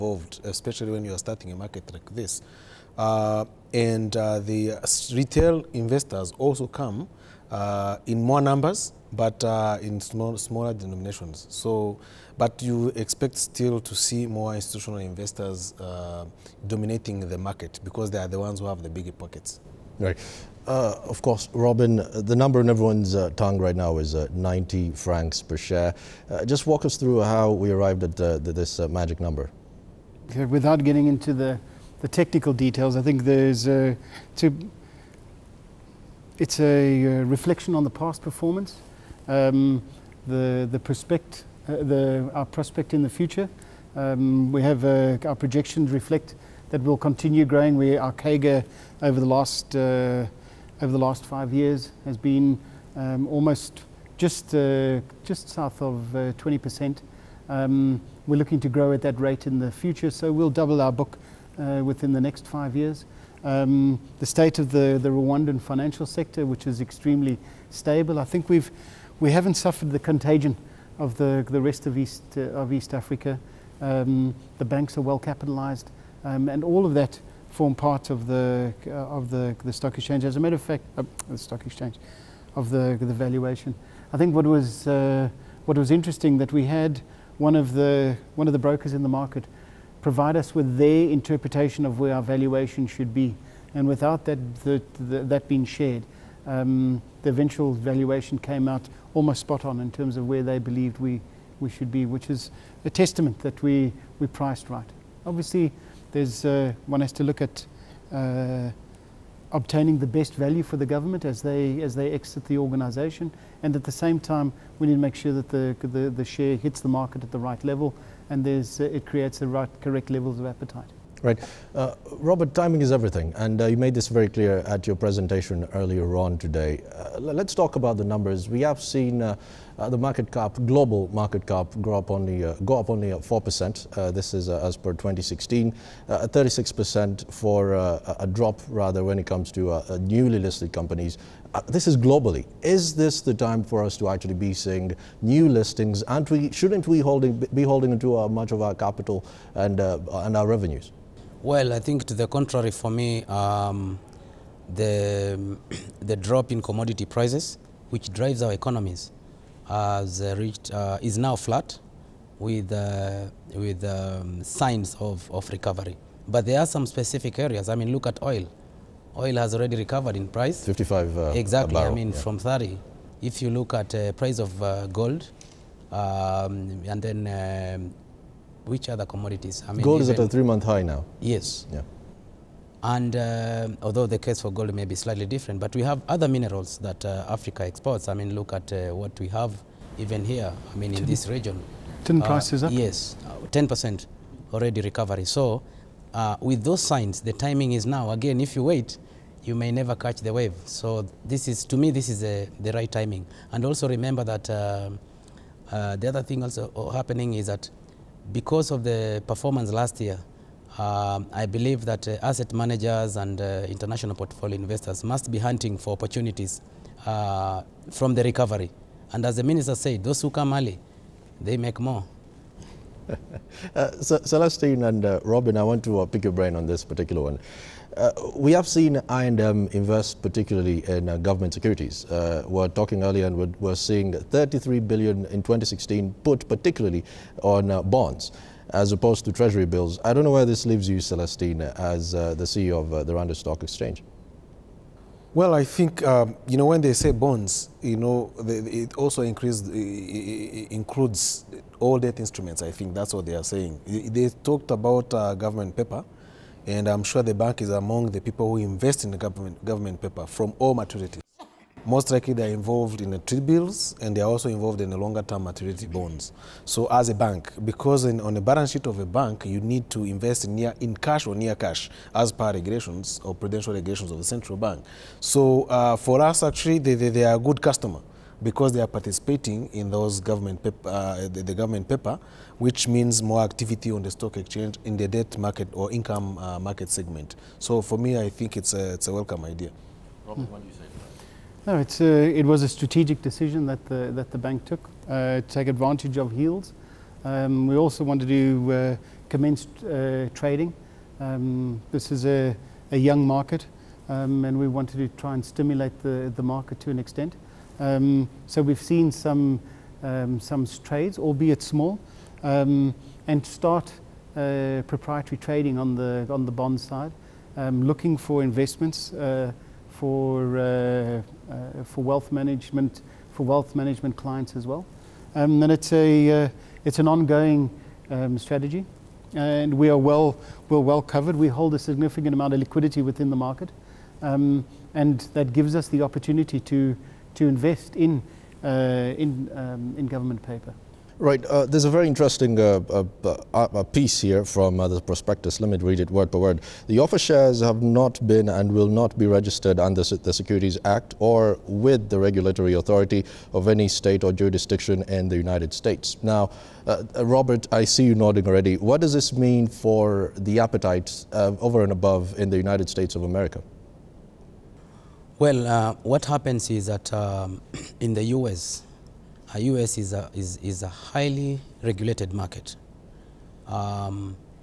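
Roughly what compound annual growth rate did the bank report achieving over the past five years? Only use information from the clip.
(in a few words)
just under 20%.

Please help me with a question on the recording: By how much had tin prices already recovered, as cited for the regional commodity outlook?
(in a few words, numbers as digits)
10%.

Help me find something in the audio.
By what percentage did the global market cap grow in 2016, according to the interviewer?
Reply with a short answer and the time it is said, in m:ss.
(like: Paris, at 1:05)
4%, at 2:13.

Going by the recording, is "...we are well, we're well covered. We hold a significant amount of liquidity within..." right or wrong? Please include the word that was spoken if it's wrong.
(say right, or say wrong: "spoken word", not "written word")
right.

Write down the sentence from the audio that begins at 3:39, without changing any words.
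And as the minister said, those who come early, they make more.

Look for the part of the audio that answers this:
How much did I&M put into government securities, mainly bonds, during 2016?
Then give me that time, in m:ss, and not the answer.
3:54.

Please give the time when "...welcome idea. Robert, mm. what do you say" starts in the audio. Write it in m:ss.
4:49.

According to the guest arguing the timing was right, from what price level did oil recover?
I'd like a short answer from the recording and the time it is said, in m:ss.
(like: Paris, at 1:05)
30, at 2:52.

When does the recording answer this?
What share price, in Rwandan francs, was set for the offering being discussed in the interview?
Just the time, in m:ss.
0:24.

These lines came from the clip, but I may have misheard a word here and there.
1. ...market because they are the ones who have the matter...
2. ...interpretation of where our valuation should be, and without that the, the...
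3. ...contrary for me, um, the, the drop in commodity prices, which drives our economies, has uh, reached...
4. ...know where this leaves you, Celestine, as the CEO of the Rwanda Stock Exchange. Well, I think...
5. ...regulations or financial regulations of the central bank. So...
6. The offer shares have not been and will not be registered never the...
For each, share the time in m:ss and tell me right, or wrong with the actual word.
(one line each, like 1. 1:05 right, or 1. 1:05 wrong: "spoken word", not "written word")
1. 0:17 wrong: "bigger", not "matter"
2. 1:31 right
3. 2:32 right
4. 4:00 right
5. 4:32 wrong: "prudential", not "financial"
6. 5:46 wrong: "under", not "never".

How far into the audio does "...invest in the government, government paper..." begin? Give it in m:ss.
4:18.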